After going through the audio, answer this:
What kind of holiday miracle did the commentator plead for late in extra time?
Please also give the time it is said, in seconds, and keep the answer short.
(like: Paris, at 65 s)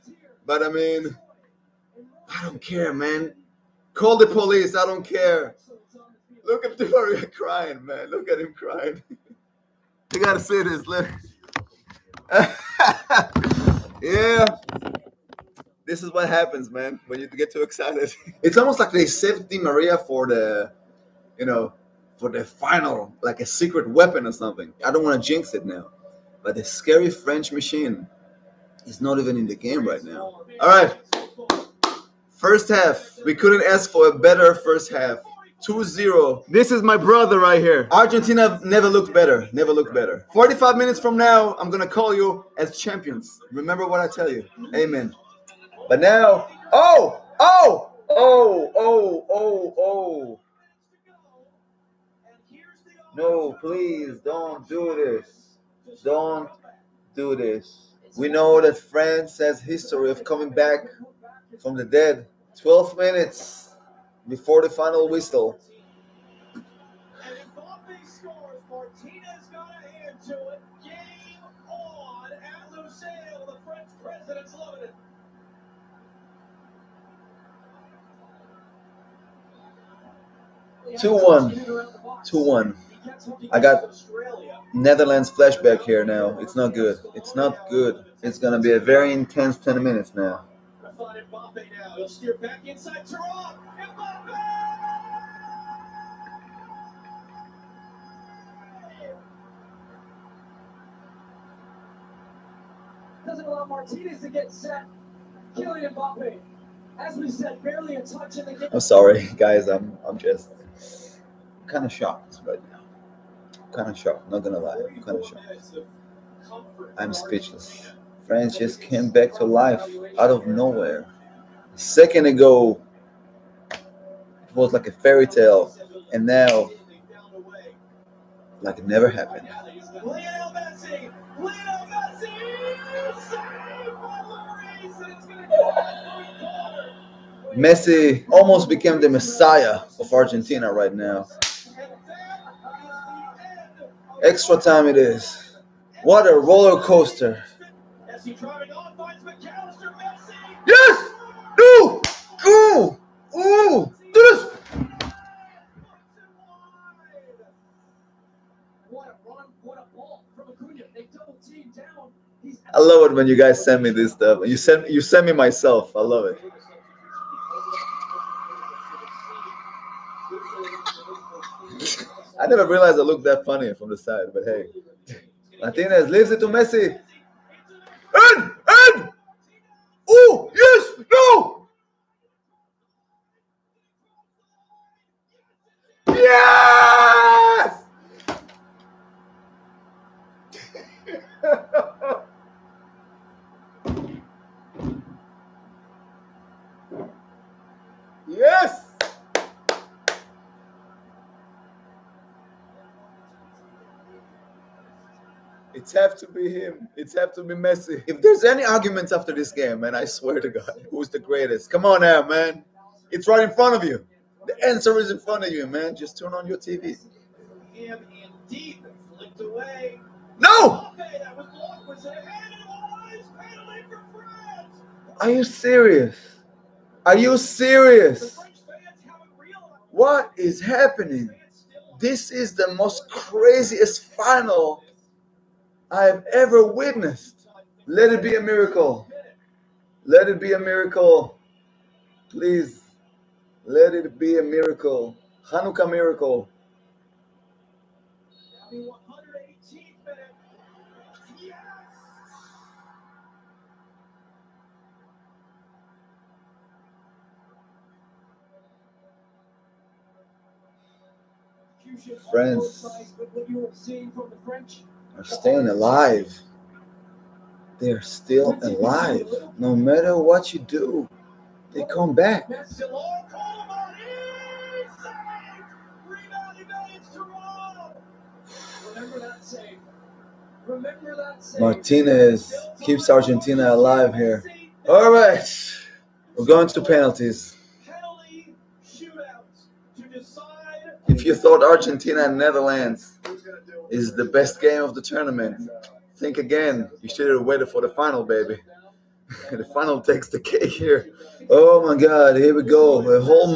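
Hanukkah miracle, at 245 s.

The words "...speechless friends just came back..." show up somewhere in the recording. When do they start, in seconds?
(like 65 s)
117 s.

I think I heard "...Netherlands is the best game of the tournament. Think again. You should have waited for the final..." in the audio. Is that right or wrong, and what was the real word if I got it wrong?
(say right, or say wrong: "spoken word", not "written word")
right.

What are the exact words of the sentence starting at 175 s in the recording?
Martinez leaves it to Messi in.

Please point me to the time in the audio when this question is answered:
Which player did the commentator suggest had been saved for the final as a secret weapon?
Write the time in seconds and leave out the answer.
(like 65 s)
19 s.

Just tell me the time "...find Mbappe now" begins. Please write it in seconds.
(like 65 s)
90 s.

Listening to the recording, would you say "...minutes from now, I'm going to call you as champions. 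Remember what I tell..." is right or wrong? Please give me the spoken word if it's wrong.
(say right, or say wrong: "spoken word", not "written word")
right.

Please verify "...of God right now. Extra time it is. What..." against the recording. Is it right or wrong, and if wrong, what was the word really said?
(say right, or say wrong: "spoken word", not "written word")
wrong: "Argentina", not "God".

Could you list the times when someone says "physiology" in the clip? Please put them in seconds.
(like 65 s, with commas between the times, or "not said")
not said.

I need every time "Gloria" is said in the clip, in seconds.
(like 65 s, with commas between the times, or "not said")
6 s.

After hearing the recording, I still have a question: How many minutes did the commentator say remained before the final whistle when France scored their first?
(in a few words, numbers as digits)
12.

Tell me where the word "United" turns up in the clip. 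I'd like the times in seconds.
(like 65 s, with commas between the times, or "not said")
not said.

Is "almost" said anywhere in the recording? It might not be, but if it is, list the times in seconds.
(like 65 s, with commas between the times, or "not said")
18 s, 138 s.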